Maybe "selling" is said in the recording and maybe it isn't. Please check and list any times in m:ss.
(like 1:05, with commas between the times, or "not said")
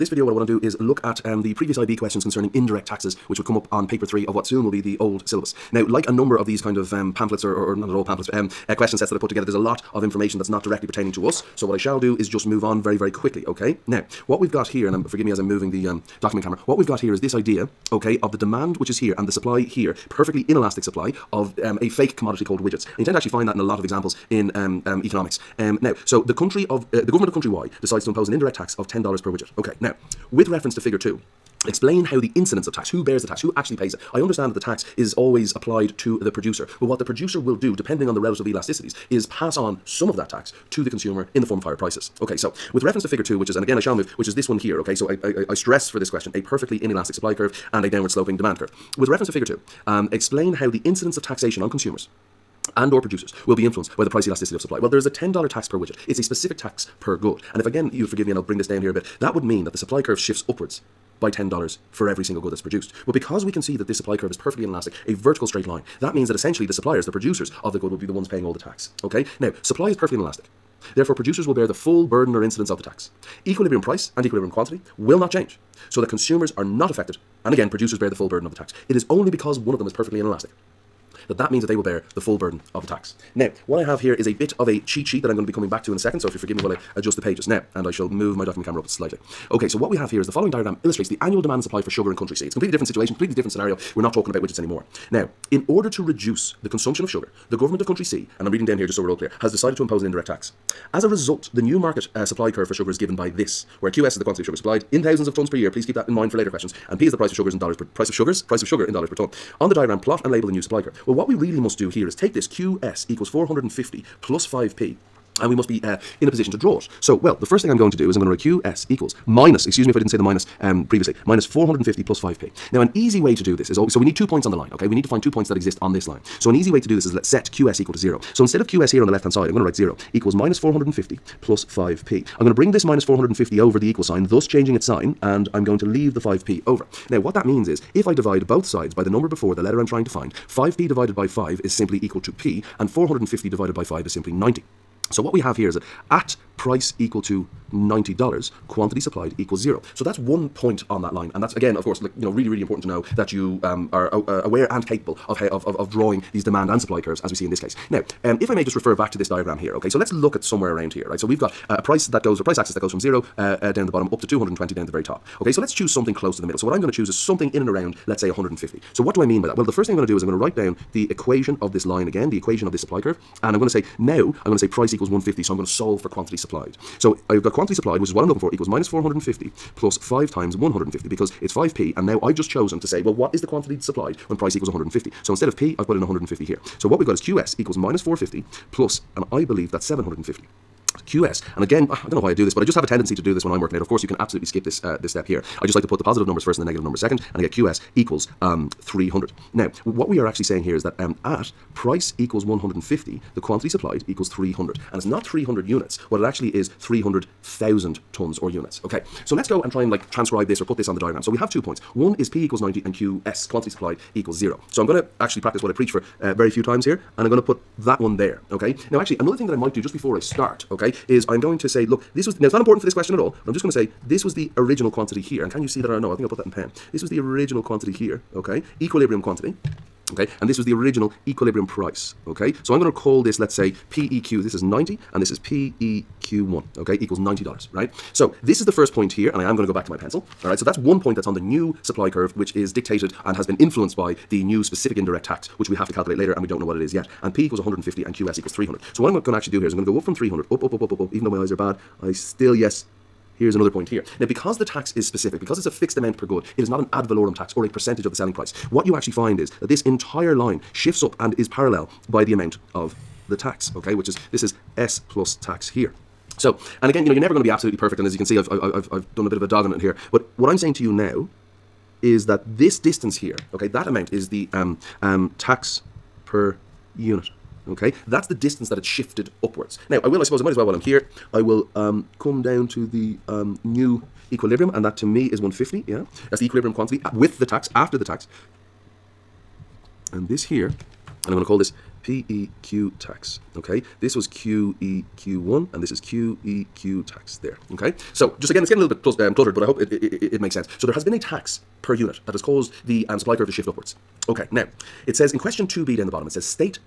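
4:18.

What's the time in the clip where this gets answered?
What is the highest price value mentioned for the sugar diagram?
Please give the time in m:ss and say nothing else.
2:44.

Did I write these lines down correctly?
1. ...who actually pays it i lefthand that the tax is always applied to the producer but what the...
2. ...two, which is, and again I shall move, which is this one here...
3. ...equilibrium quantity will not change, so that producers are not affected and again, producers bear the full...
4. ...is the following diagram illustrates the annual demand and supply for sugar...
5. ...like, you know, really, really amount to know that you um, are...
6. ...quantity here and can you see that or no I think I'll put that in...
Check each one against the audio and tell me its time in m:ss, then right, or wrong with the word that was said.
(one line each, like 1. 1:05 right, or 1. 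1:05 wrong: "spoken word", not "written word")
1. 0:33 wrong: "understand", not "lefthand"
2. 0:43 right
3. 1:14 wrong: "consumers", not "producers"
4. 1:30 right
5. 2:32 wrong: "important", not "amount"
6. 3:44 right.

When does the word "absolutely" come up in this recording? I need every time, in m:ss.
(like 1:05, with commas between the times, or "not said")
3:14, 4:27.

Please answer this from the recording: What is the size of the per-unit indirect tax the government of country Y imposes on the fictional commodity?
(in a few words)
$10.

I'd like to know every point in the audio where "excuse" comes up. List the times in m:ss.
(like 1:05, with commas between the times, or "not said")
1:59.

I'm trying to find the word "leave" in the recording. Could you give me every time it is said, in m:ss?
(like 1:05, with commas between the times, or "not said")
2:15.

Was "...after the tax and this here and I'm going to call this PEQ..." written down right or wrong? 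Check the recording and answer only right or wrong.
right.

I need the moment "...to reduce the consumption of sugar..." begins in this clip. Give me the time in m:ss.
1:35.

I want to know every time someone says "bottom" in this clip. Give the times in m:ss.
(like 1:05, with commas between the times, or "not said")
2:43, 5:06.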